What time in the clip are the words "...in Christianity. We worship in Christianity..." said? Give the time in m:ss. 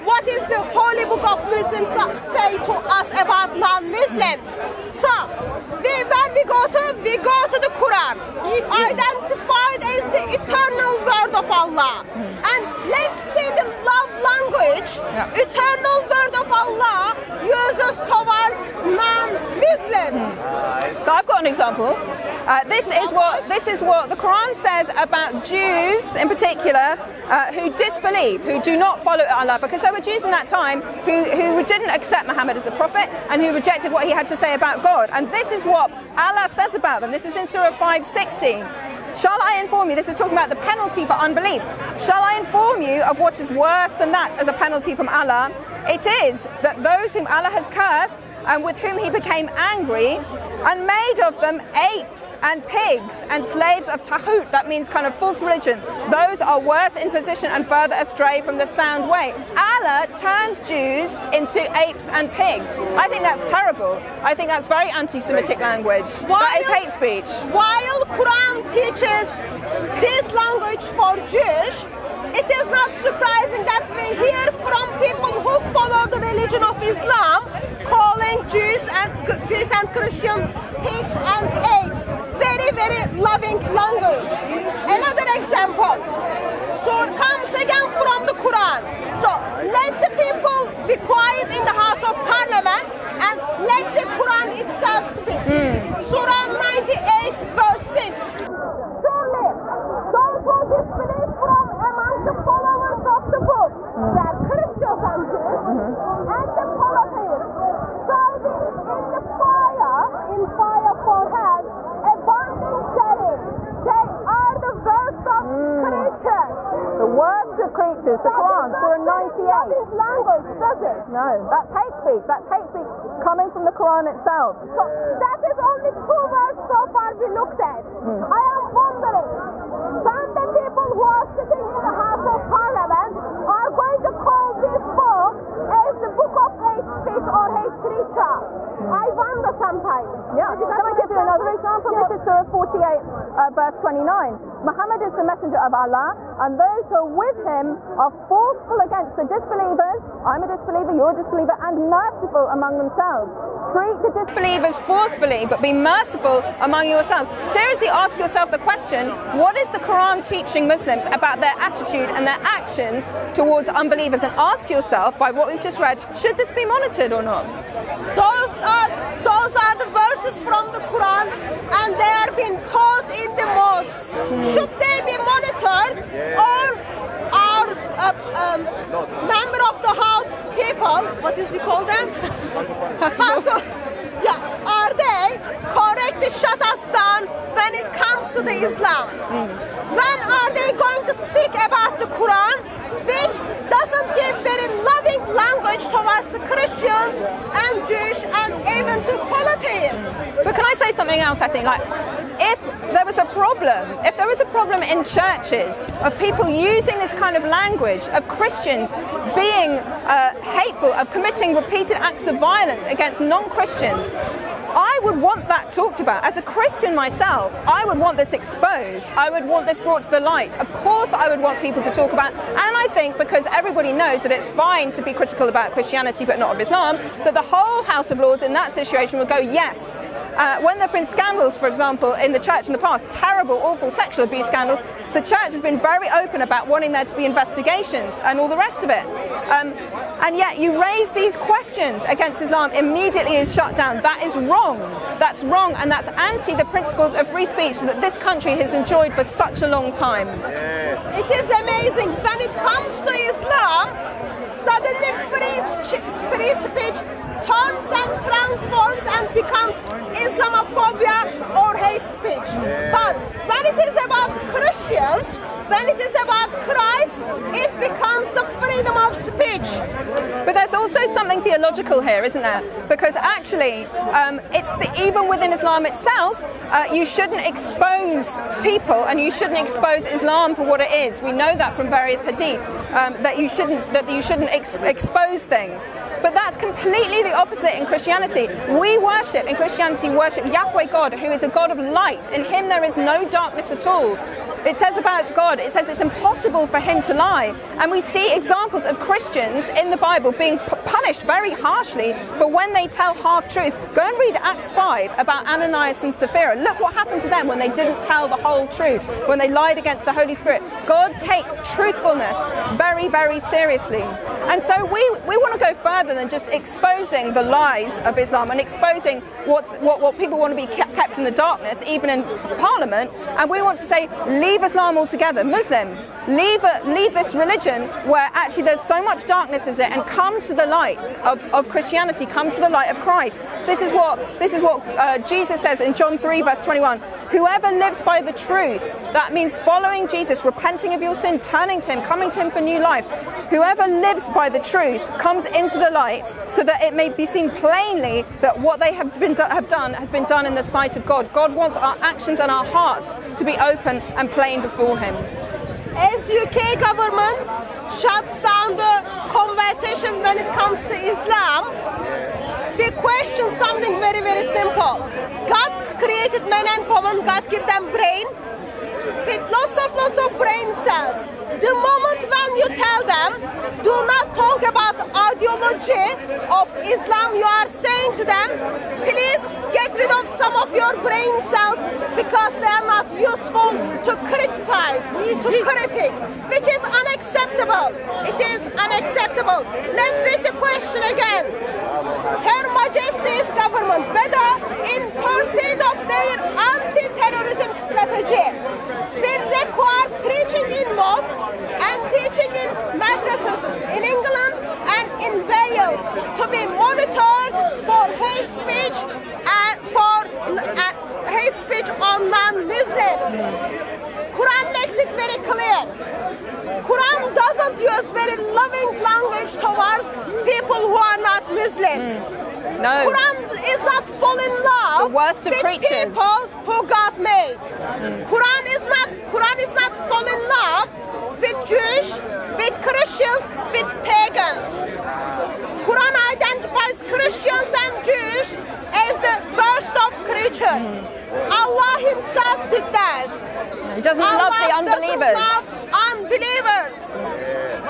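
4:47.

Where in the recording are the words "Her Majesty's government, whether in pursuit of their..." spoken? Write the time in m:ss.
6:32.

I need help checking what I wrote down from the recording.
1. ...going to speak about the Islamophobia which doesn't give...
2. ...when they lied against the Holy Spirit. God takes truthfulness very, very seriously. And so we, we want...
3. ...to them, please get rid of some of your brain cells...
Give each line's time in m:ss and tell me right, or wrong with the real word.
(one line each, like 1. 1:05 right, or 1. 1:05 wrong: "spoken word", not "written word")
1. 3:10 wrong: "Quran", not "Islamophobia"
2. 5:09 right
3. 6:18 right.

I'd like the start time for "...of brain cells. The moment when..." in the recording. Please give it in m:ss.
6:10.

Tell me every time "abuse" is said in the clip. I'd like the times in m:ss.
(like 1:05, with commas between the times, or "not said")
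3:54.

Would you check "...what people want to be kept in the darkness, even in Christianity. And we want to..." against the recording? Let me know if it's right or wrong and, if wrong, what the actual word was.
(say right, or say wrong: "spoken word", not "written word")
wrong: "Parliament", not "Christianity".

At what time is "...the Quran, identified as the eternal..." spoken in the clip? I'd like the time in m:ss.
0:07.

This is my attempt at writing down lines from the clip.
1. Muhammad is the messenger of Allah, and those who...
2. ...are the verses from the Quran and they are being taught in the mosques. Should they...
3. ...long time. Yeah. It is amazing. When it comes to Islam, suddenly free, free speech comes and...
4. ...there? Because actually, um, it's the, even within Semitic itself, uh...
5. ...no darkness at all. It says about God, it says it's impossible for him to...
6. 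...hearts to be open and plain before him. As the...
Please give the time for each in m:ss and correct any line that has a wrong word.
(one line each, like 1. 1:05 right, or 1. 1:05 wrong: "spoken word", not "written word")
1. 2:24 right
2. 2:49 right
3. 4:09 right
4. 4:32 wrong: "Islam", not "Semitic"
5. 4:52 right
6. 5:52 right.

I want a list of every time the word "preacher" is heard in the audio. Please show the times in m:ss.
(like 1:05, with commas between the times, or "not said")
2:17, 7:05.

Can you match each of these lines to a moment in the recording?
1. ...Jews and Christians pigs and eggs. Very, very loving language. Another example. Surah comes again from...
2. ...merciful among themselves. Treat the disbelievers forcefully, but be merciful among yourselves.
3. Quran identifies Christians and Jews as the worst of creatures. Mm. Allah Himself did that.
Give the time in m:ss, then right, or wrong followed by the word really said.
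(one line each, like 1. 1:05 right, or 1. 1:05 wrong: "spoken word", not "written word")
1. 1:19 right
2. 2:31 right
3. 7:15 right.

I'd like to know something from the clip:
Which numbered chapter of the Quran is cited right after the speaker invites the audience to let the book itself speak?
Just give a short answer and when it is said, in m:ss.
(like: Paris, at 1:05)
Surah 98, at 1:58.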